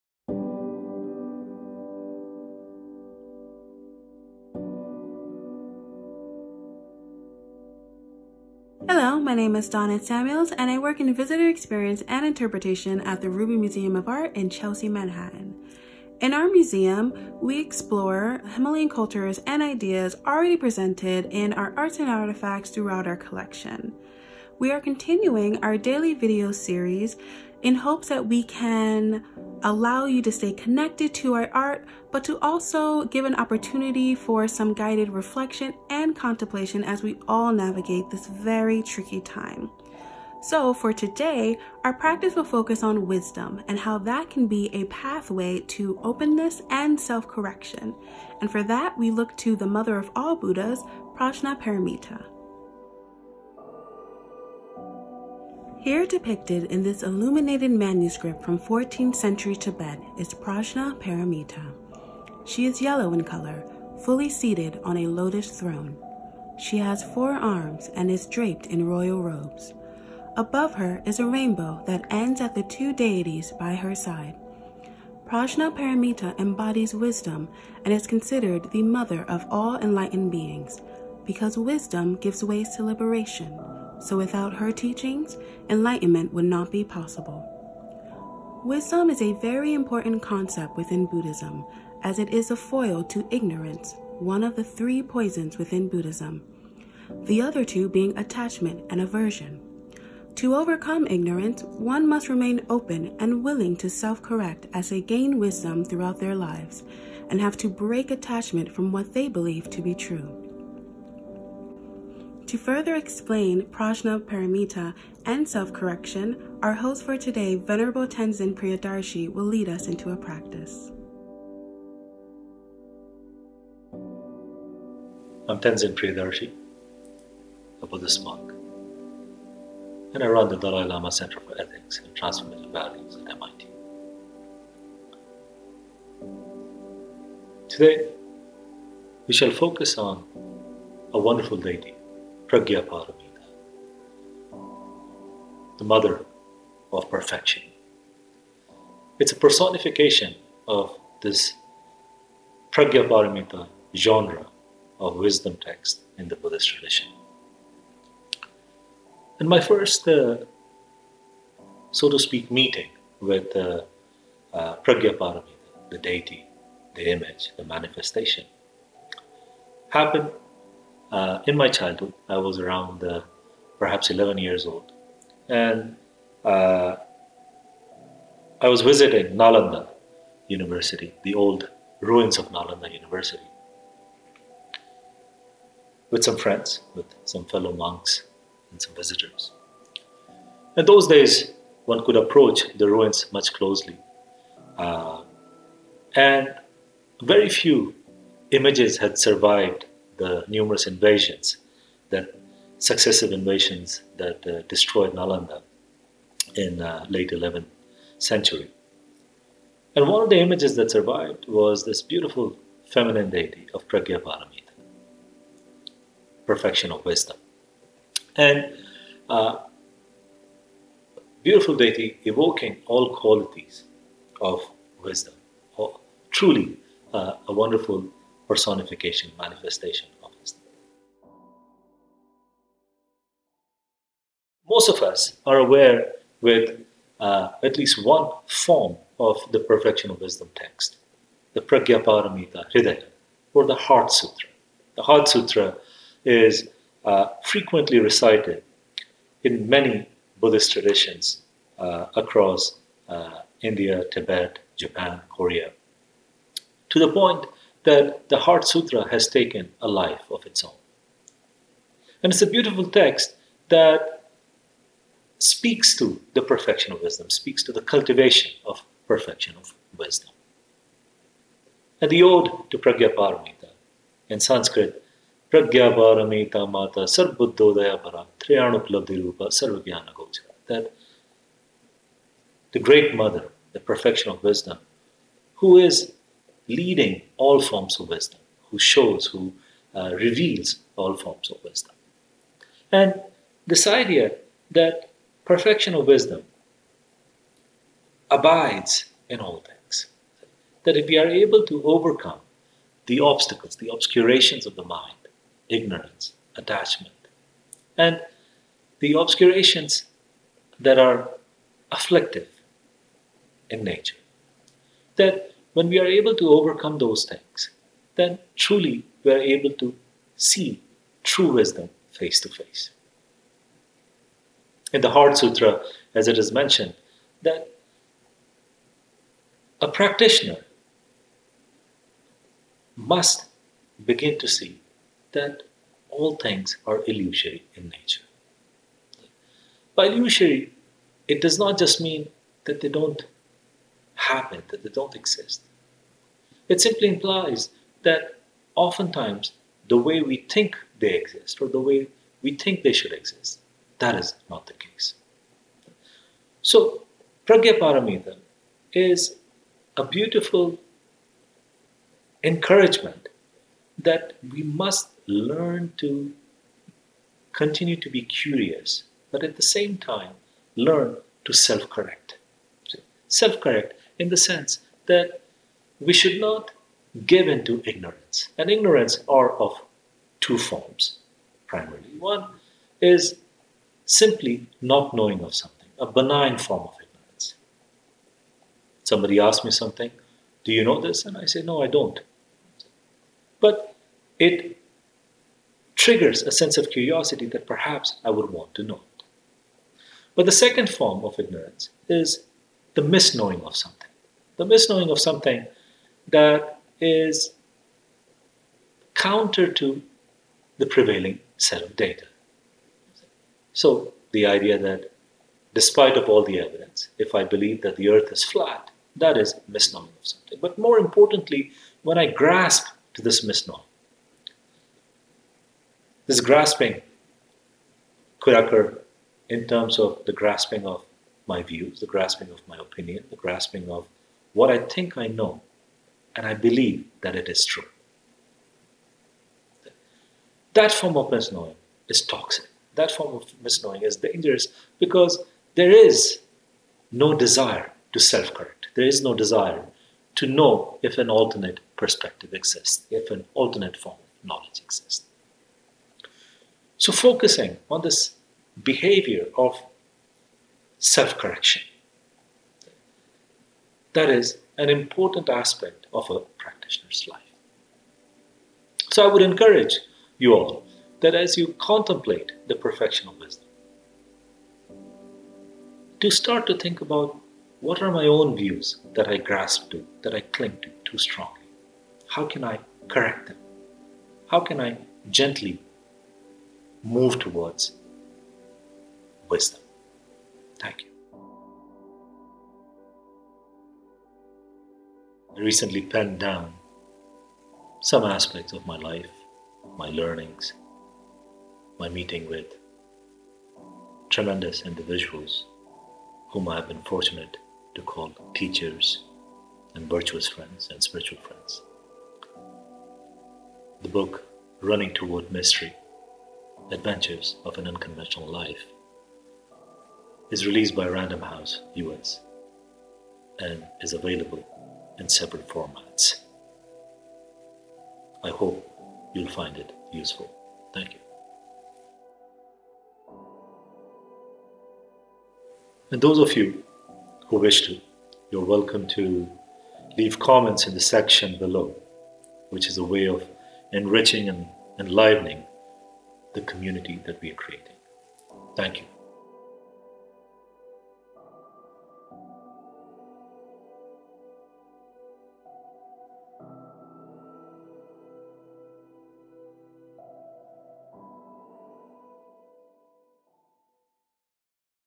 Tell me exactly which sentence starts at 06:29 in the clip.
Somebody asks me something, Do you know this?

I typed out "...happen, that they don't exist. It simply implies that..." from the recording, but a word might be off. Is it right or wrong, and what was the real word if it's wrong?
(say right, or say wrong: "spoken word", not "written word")
right.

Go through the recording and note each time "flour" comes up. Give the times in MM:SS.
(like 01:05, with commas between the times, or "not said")
not said.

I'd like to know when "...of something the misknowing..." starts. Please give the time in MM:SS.
06:43.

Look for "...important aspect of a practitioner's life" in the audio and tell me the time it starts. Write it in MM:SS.
07:44.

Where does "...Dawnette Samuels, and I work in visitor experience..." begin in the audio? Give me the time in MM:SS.
00:09.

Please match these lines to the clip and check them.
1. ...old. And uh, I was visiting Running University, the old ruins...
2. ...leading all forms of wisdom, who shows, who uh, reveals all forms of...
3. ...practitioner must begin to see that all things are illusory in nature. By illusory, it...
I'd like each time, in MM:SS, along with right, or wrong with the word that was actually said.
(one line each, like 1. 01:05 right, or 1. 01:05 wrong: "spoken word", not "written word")
1. 02:54 wrong: "Nalanda", not "Running"
2. 04:46 right
3. 05:29 right.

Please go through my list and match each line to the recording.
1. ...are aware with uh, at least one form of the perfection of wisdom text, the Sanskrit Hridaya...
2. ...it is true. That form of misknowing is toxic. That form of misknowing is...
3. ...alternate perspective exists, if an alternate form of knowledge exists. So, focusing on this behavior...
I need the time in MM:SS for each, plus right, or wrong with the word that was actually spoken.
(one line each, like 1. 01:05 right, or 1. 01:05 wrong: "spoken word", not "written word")
1. 03:55 wrong: "Pragyaparamita", not "Sanskrit"
2. 07:17 right
3. 07:31 right.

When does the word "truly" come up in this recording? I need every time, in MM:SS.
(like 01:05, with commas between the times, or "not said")
03:46, 05:18.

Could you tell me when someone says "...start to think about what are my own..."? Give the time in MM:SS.
07:56.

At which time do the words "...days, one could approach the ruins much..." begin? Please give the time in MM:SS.
03:11.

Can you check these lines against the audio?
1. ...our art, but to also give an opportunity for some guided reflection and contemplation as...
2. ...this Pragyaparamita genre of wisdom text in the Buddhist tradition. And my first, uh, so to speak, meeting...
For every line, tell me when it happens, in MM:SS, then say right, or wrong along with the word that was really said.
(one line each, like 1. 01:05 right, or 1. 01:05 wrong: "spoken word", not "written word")
1. 00:31 right
2. 02:31 right.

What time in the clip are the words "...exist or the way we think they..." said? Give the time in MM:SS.
05:51.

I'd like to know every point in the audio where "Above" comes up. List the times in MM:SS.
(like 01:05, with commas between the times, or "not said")
01:10.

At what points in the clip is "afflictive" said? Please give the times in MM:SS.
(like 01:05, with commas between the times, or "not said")
05:11.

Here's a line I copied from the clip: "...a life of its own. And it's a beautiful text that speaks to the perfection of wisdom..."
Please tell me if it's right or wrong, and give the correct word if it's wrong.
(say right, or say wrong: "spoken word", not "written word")
right.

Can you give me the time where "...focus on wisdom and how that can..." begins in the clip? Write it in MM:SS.
00:42.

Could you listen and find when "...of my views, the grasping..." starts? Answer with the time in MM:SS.
07:10.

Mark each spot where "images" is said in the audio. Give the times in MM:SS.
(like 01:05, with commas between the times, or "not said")
02:47, 03:18, 03:30.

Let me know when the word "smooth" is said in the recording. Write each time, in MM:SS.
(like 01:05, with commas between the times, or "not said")
not said.